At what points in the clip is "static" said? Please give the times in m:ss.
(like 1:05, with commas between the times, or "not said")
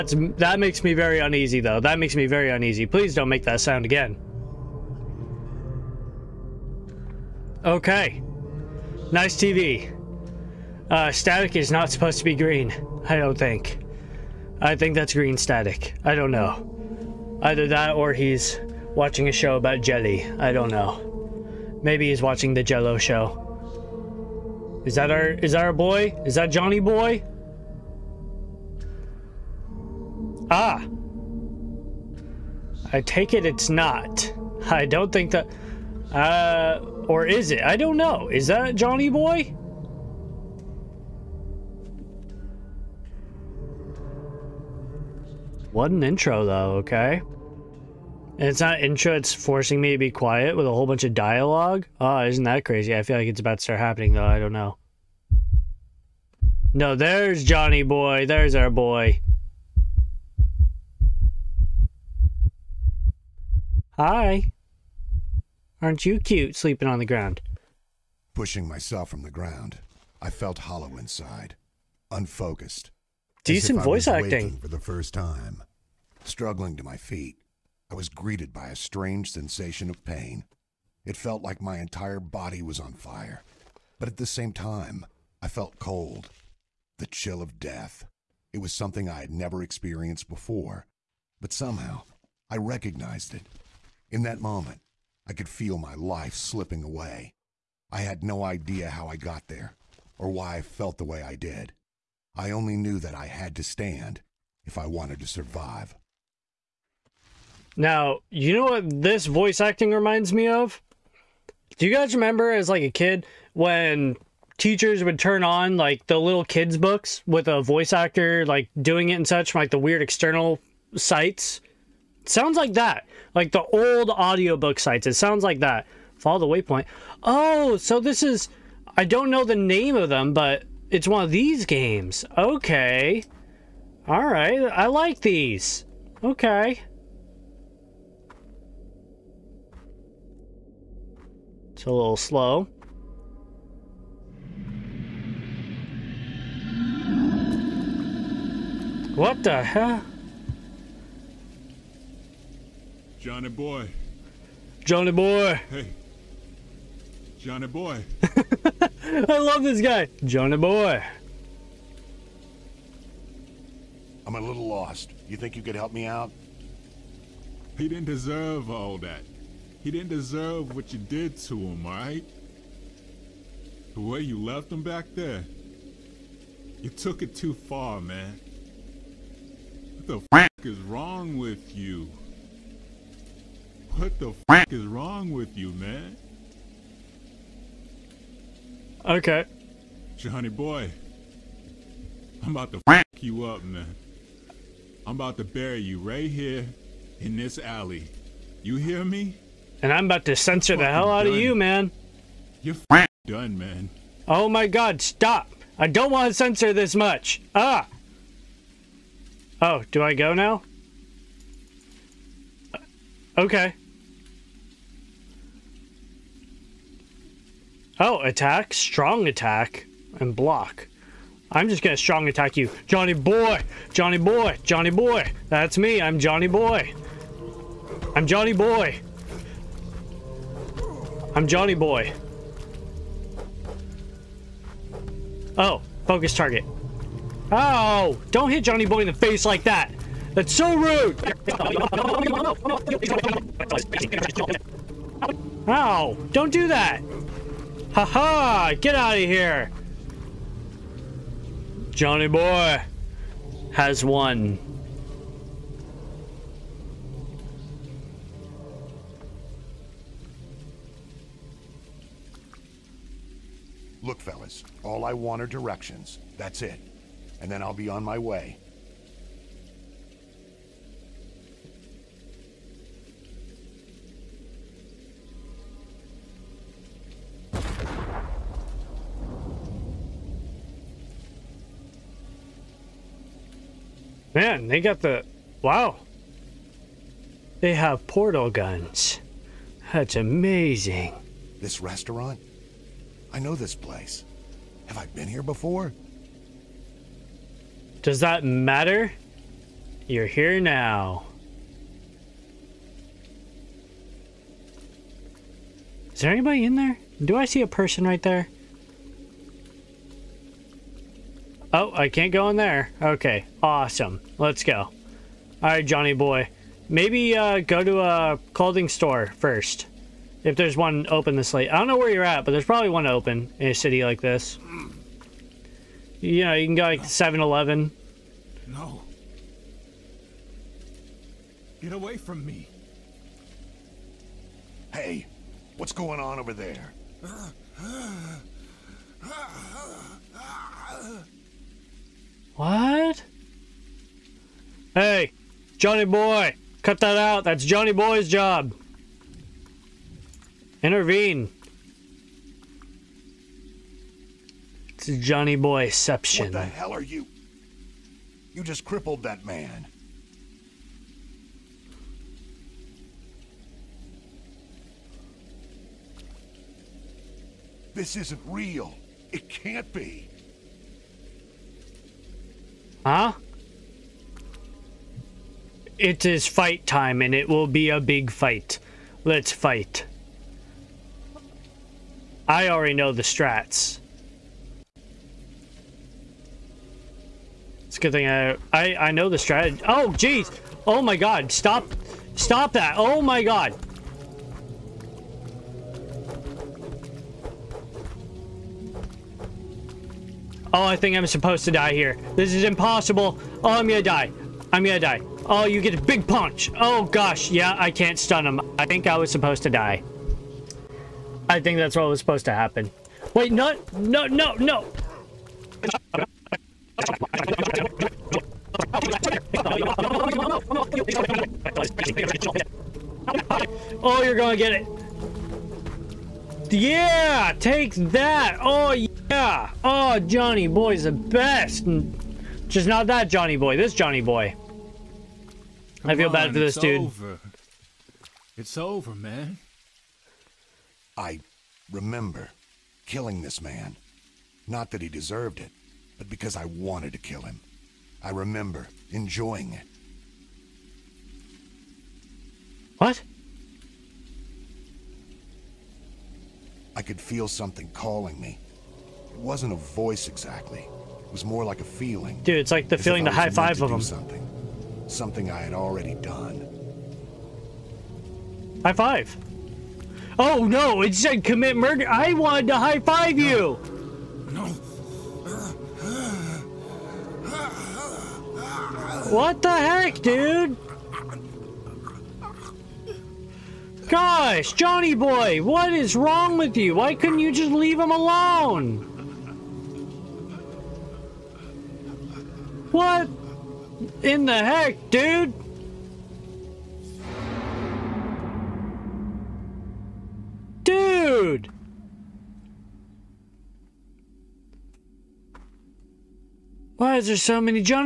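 0:11, 0:15.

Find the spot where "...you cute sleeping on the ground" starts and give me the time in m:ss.
1:06.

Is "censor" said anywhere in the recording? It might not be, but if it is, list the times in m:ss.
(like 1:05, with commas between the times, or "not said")
3:20, 3:26.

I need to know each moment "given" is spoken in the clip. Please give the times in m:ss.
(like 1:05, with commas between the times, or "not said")
not said.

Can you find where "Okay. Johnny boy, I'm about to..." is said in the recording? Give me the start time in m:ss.
3:09.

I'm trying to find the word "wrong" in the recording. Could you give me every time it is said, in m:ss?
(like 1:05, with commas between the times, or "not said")
3:00, 3:04, 8:06.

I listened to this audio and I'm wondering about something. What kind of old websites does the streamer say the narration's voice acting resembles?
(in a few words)
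audiobook sites.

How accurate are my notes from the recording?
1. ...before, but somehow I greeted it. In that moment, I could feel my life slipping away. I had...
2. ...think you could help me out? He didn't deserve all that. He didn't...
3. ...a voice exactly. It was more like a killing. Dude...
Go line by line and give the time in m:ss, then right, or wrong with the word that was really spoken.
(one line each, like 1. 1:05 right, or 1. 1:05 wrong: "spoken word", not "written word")
1. 1:30 wrong: "recognized", not "greeted"
2. 2:45 right
3. 7:39 wrong: "feeling", not "killing".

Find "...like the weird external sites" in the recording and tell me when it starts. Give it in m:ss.
1:59.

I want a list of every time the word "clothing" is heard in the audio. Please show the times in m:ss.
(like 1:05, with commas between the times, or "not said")
5:18.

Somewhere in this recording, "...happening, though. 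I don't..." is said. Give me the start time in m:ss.
0:53.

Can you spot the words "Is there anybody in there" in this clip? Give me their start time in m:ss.
5:06.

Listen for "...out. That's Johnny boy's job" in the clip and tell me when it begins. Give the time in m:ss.
5:47.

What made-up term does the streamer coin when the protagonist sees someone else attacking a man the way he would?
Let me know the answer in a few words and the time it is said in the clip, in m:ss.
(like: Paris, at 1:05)
Johnny Boyception, at 5:55.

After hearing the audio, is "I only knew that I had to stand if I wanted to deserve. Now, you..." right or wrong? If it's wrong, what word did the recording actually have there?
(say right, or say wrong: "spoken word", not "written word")
wrong: "survive", not "deserve".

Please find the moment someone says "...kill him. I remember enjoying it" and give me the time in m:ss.
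7:27.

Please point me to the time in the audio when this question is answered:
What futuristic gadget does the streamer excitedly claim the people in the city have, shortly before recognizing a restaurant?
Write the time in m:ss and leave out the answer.
4:48.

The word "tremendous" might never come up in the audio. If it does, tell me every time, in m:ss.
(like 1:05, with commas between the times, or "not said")
not said.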